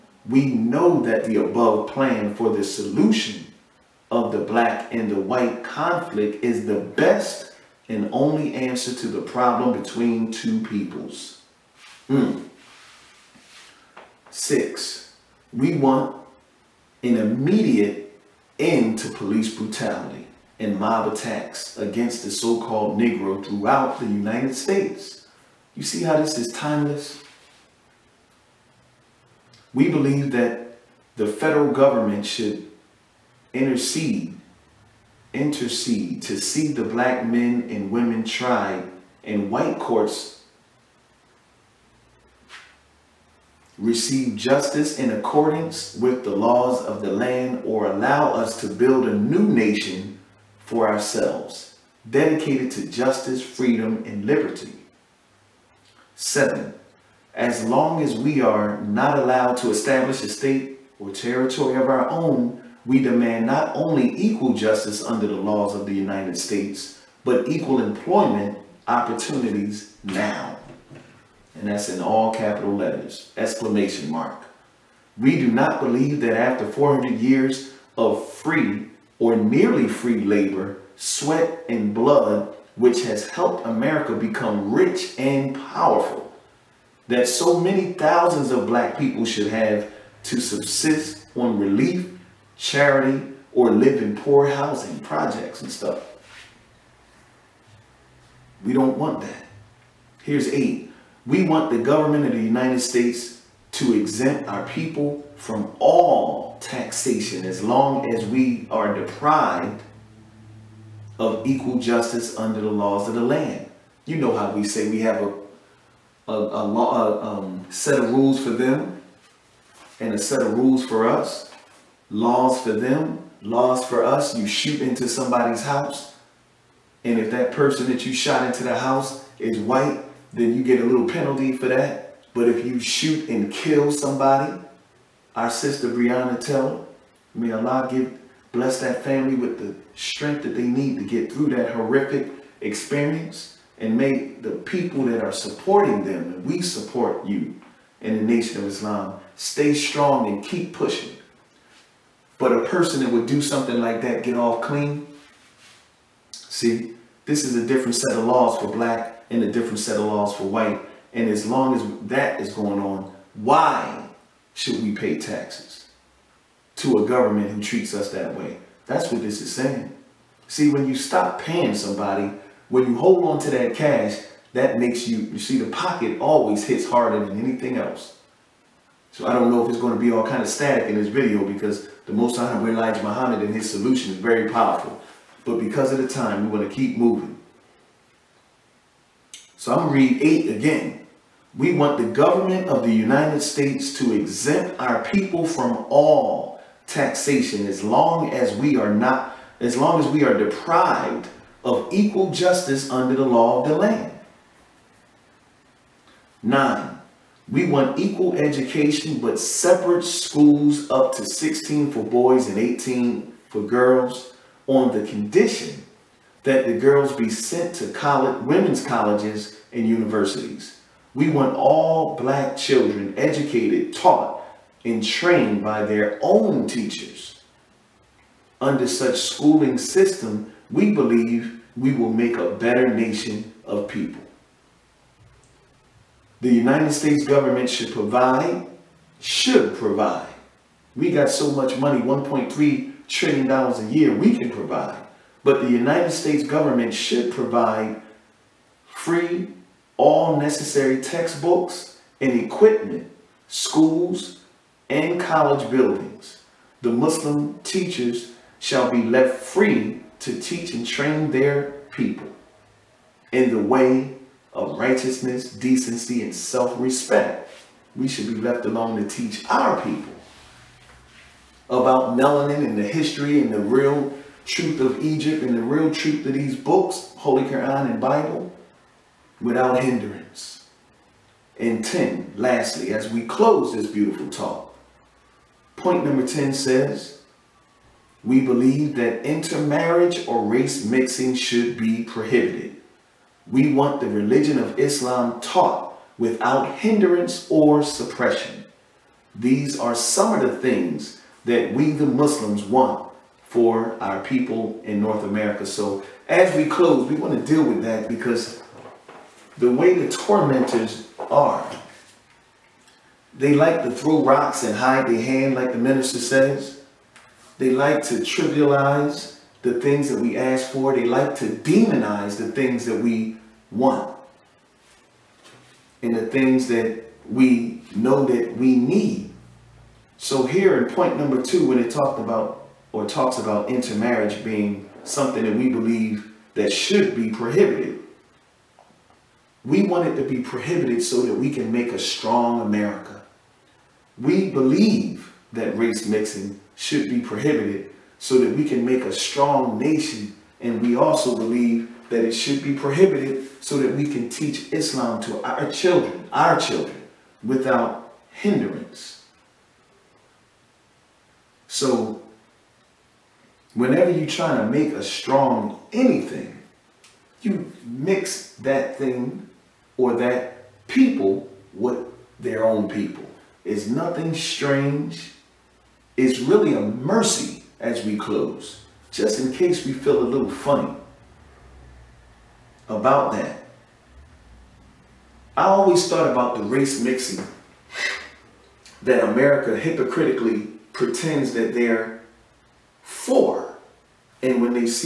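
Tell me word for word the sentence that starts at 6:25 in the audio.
I always thought about the race mixing that America hypocritically pretends that they're for.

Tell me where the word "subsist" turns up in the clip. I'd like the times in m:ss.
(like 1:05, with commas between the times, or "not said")
1:30.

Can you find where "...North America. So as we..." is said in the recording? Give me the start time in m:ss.
5:05.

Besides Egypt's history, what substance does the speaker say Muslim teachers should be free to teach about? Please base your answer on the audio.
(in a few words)
Melanin.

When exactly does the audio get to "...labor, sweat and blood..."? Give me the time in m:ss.
1:20.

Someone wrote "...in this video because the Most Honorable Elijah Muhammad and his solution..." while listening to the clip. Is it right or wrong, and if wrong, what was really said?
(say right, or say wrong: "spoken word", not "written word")
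right.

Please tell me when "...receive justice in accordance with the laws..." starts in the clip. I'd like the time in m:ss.
0:43.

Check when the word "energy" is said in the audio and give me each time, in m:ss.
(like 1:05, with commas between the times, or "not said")
not said.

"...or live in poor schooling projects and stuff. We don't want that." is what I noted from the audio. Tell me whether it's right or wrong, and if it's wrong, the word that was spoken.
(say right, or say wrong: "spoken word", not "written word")
wrong: "housing", not "schooling".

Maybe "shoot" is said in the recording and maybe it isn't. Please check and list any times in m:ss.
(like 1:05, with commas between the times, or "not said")
2:04, 2:12.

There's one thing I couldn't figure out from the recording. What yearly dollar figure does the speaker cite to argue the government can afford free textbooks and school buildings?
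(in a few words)
$1.3 trillion.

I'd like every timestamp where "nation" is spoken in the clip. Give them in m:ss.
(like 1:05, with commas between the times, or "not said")
0:49, 2:28, 3:52, 5:49.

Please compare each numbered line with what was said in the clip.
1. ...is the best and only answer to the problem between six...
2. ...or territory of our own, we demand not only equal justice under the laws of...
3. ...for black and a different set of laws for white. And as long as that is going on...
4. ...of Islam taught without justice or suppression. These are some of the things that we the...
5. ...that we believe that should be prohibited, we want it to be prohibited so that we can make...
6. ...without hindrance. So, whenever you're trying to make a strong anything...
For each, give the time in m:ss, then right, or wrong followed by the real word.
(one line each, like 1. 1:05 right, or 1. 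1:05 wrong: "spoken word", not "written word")
1. 0:06 wrong: "two", not "six"
2. 1:00 right
3. 2:38 right
4. 4:54 wrong: "hindrance", not "justice"
5. 5:35 right
6. 5:57 right.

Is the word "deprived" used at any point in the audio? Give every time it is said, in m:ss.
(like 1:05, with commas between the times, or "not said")
1:48, 3:20.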